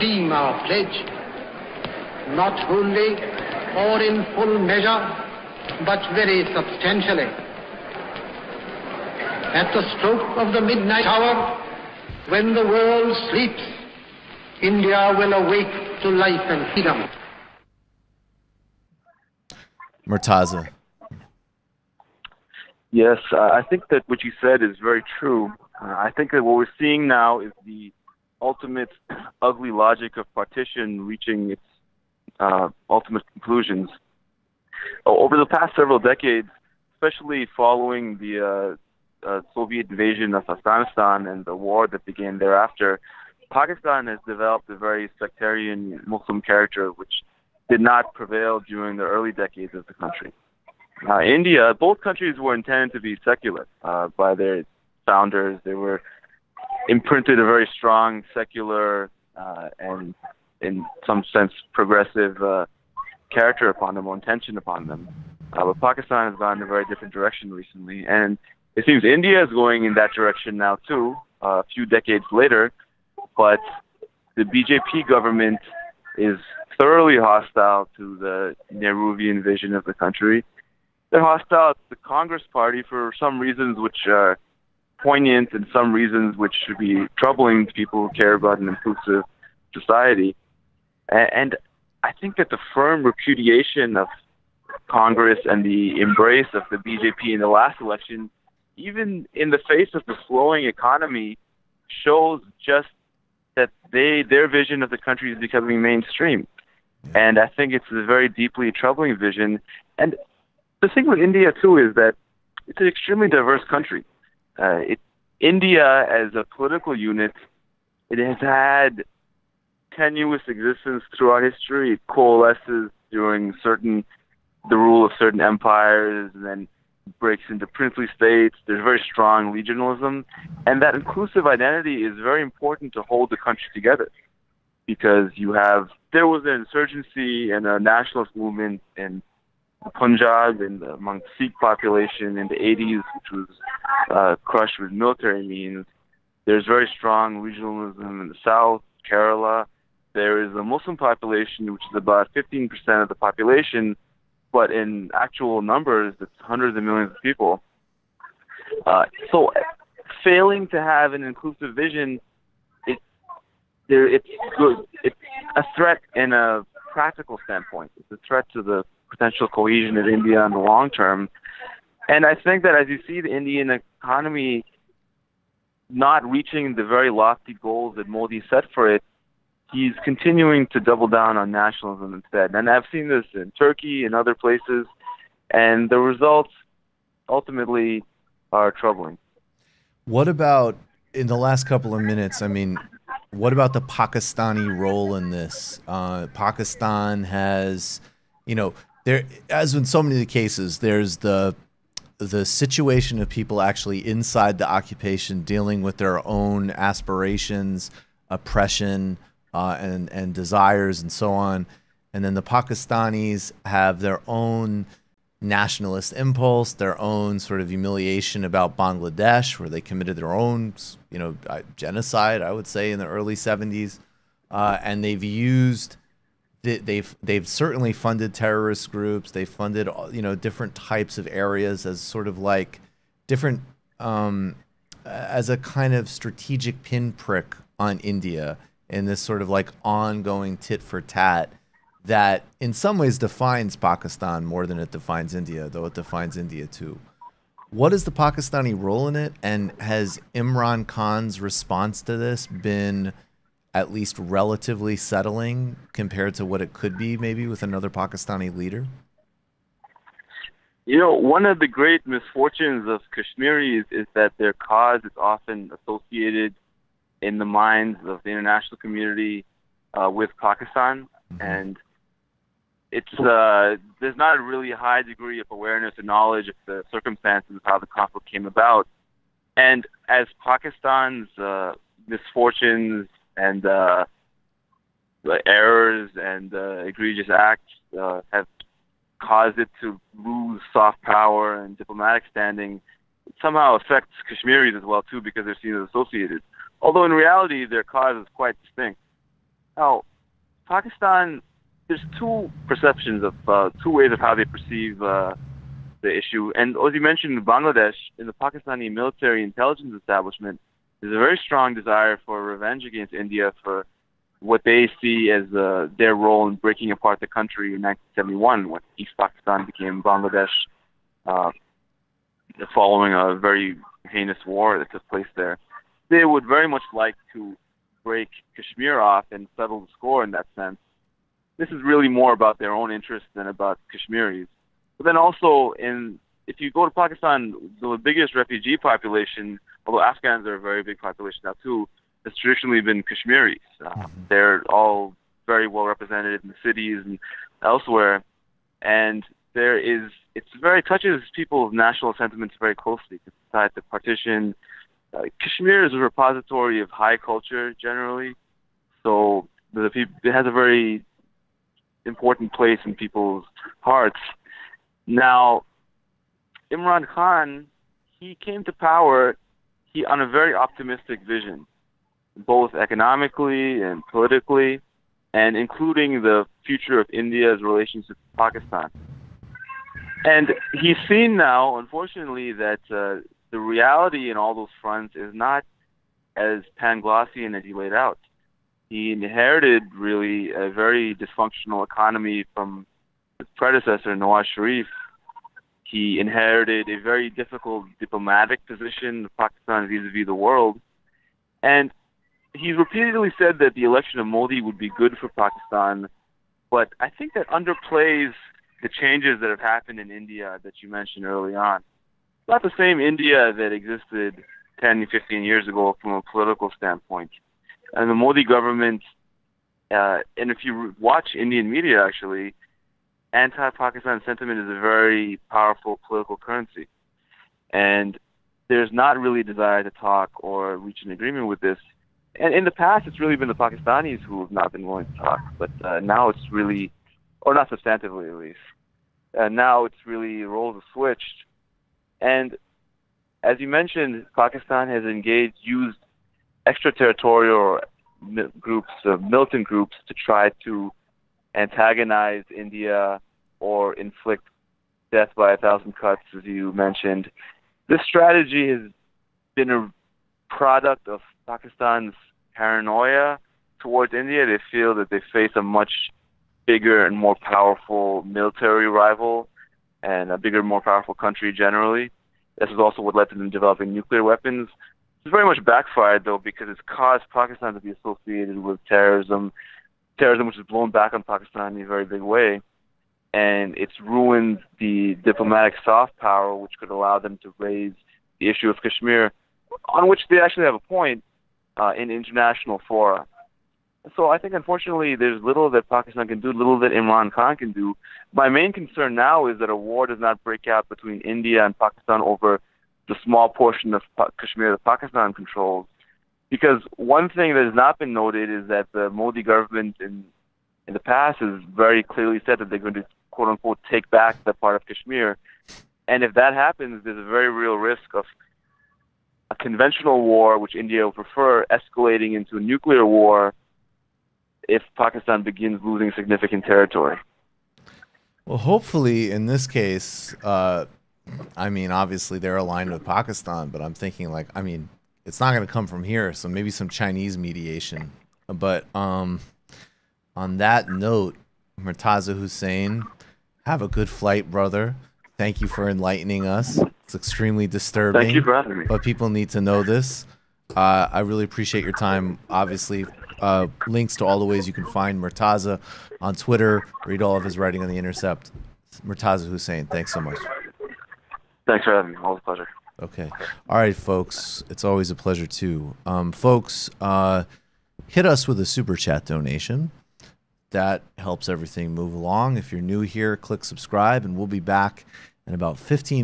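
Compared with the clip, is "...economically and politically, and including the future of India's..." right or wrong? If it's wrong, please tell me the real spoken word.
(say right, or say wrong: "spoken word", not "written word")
right.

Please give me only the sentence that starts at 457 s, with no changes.
This strategy has been a product of Pakistan's paranoia towards India.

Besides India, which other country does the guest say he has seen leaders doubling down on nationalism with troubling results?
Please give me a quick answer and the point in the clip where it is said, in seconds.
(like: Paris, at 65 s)
Turkey, at 183 s.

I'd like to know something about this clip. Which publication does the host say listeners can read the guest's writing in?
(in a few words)
The Intercept.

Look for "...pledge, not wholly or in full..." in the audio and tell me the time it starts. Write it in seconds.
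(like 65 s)
0 s.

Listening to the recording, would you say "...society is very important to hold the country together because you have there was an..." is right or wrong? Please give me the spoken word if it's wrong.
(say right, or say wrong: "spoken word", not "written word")
wrong: "identity", not "society".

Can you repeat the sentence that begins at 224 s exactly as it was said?
Uh, and they've used, they've, they've certainly funded terrorist groups.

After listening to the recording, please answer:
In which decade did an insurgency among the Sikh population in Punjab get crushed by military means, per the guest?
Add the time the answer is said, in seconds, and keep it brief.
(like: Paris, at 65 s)
The 80s, at 142 s.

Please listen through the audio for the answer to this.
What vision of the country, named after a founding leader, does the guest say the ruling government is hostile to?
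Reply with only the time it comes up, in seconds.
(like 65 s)
78 s.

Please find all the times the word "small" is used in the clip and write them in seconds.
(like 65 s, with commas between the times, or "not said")
503 s.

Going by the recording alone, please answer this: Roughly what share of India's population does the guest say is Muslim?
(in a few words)
15%.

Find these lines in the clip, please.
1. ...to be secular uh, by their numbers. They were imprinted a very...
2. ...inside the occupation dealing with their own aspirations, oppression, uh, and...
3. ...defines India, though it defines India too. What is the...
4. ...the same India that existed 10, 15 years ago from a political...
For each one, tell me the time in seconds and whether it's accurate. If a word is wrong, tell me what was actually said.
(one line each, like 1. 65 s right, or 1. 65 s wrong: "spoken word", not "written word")
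1. 52 s wrong: "founders", not "numbers"
2. 204 s right
3. 244 s right
4. 412 s right.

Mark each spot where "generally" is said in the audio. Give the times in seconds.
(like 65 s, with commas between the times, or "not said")
357 s, 471 s.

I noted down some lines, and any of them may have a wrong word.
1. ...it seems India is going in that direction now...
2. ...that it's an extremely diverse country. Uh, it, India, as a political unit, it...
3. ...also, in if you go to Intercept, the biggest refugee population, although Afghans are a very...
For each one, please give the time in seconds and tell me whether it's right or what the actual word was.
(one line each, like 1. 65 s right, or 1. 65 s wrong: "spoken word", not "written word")
1. 68 s right
2. 111 s right
3. 335 s wrong: "Pakistan", not "Intercept".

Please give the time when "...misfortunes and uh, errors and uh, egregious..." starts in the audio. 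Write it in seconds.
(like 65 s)
282 s.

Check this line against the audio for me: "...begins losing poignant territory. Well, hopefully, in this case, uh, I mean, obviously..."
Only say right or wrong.
wrong.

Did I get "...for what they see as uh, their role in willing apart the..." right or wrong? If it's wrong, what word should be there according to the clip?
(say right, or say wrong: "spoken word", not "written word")
wrong: "breaking", not "willing".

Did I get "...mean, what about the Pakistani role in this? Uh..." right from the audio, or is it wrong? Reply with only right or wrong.
right.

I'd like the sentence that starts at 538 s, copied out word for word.
But um, on that note, Murtaza Hussain, have a good flight, brother.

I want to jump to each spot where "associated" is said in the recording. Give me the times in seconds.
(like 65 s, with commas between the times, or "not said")
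265 s, 295 s, 477 s.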